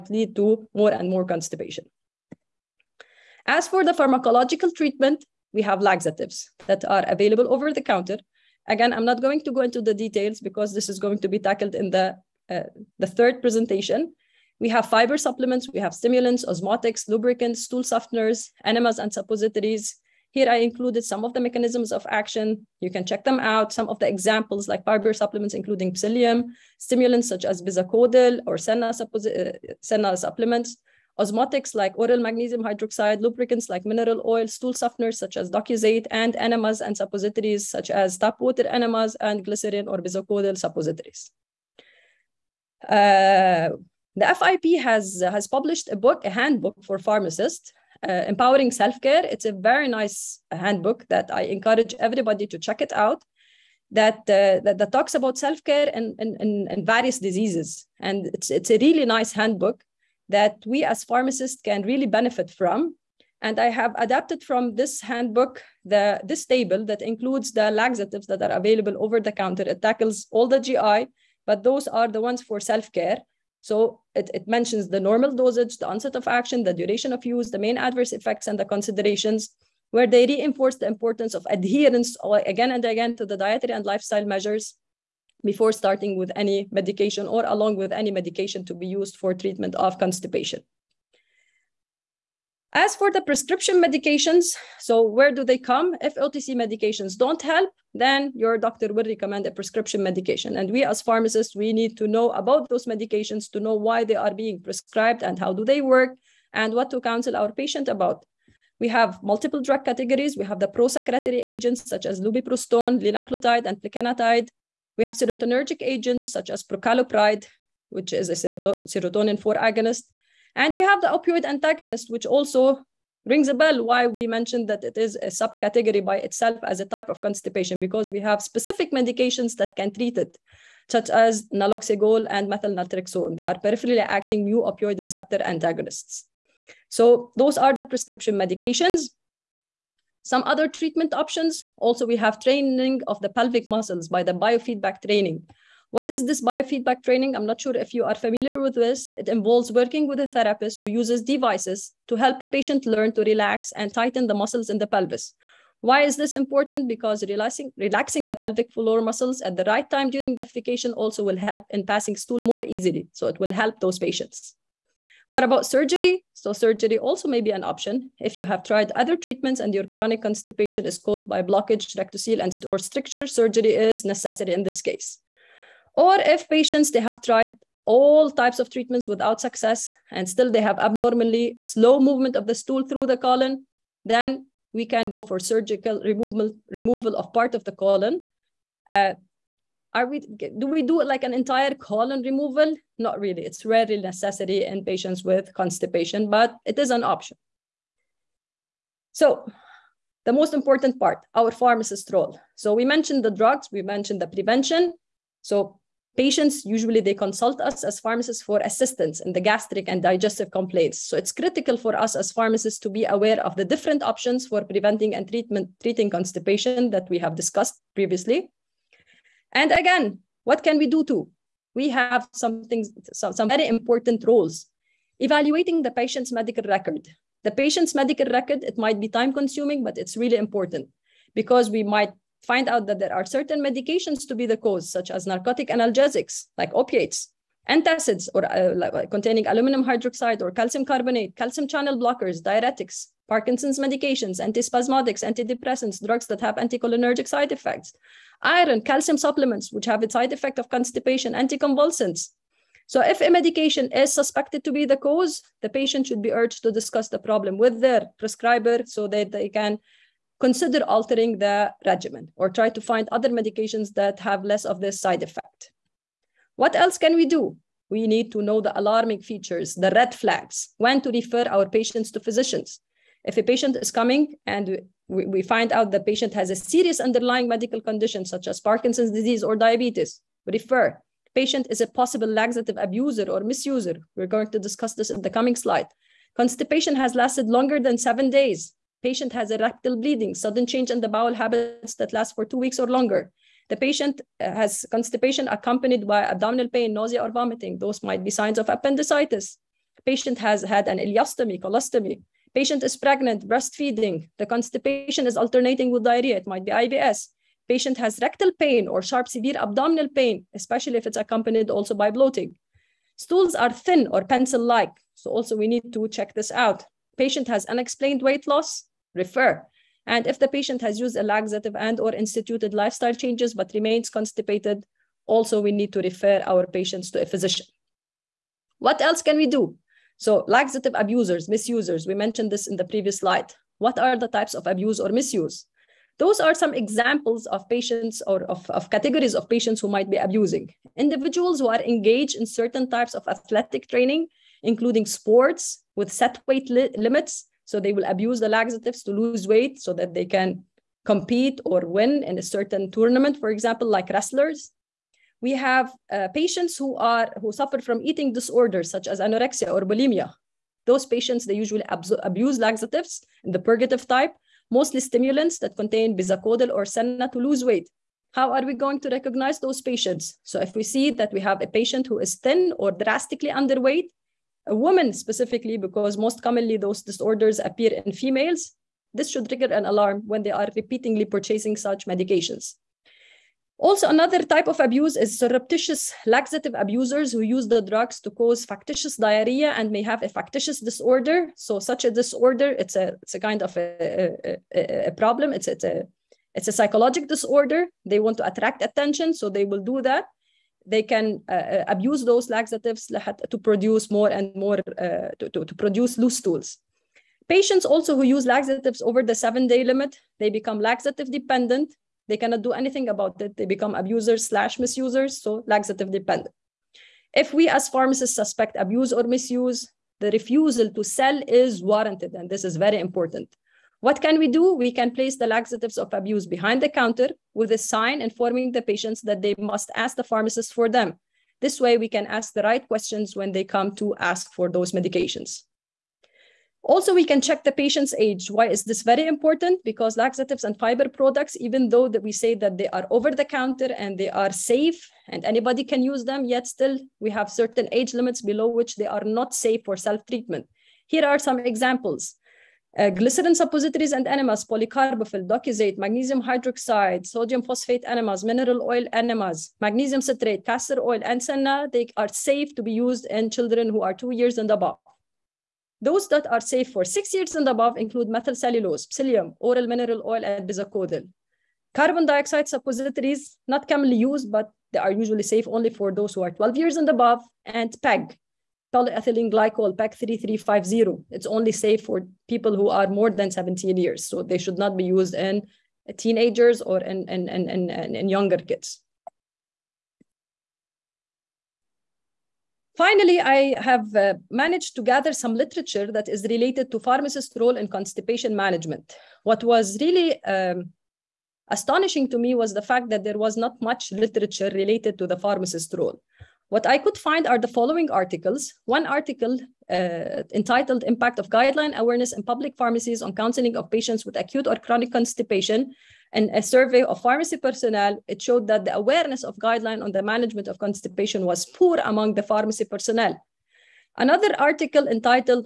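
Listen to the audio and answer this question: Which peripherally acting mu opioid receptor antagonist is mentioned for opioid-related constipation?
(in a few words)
naloxegol.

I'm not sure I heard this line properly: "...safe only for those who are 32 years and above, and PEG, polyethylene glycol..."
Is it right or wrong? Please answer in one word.
wrong.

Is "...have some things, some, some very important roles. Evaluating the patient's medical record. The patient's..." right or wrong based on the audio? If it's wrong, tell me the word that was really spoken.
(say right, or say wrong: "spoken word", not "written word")
right.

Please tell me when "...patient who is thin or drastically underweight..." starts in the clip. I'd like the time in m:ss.
6:11.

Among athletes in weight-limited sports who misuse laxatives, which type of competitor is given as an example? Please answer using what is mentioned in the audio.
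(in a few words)
wrestlers.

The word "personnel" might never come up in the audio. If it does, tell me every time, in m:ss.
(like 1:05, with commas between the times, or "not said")
8:37, 8:42.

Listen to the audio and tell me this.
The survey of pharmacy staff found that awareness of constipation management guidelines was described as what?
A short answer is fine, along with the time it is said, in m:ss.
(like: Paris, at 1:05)
poor, at 8:41.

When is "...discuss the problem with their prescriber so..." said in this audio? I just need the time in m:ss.
4:16.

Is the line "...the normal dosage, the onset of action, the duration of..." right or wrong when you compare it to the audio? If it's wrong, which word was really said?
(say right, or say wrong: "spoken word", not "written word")
right.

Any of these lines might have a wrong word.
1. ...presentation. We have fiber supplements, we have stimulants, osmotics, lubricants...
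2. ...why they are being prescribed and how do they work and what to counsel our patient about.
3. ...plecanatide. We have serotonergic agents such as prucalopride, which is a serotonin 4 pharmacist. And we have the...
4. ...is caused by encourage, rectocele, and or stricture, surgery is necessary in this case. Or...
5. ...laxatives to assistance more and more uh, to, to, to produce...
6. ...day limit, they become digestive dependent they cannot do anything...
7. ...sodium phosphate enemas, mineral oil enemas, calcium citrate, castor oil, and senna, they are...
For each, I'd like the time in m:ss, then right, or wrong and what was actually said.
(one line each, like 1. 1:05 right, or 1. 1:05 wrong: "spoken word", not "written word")
1. 0:13 right
2. 1:43 right
3. 1:53 wrong: "agonist", not "pharmacist"
4. 2:50 wrong: "blockage", not "encourage"
5. 6:42 wrong: "produce", not "assistance"
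6. 6:49 wrong: "laxative", not "digestive"
7. 7:37 wrong: "magnesium", not "calcium".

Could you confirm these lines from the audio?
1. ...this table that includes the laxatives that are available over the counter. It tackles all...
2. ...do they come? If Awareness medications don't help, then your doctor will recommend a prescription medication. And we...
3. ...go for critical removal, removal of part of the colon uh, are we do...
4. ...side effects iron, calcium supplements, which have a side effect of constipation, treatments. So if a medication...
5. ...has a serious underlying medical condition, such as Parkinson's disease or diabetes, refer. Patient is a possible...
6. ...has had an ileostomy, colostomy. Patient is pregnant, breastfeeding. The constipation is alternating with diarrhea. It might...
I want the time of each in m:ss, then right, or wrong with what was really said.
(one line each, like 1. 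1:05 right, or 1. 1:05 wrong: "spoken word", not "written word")
1. 1:06 right
2. 1:35 wrong: "OTC", not "Awareness"
3. 3:05 wrong: "surgical", not "critical"
4. 4:07 wrong: "anticonvulsants", not "treatments"
5. 4:36 right
6. 5:00 right.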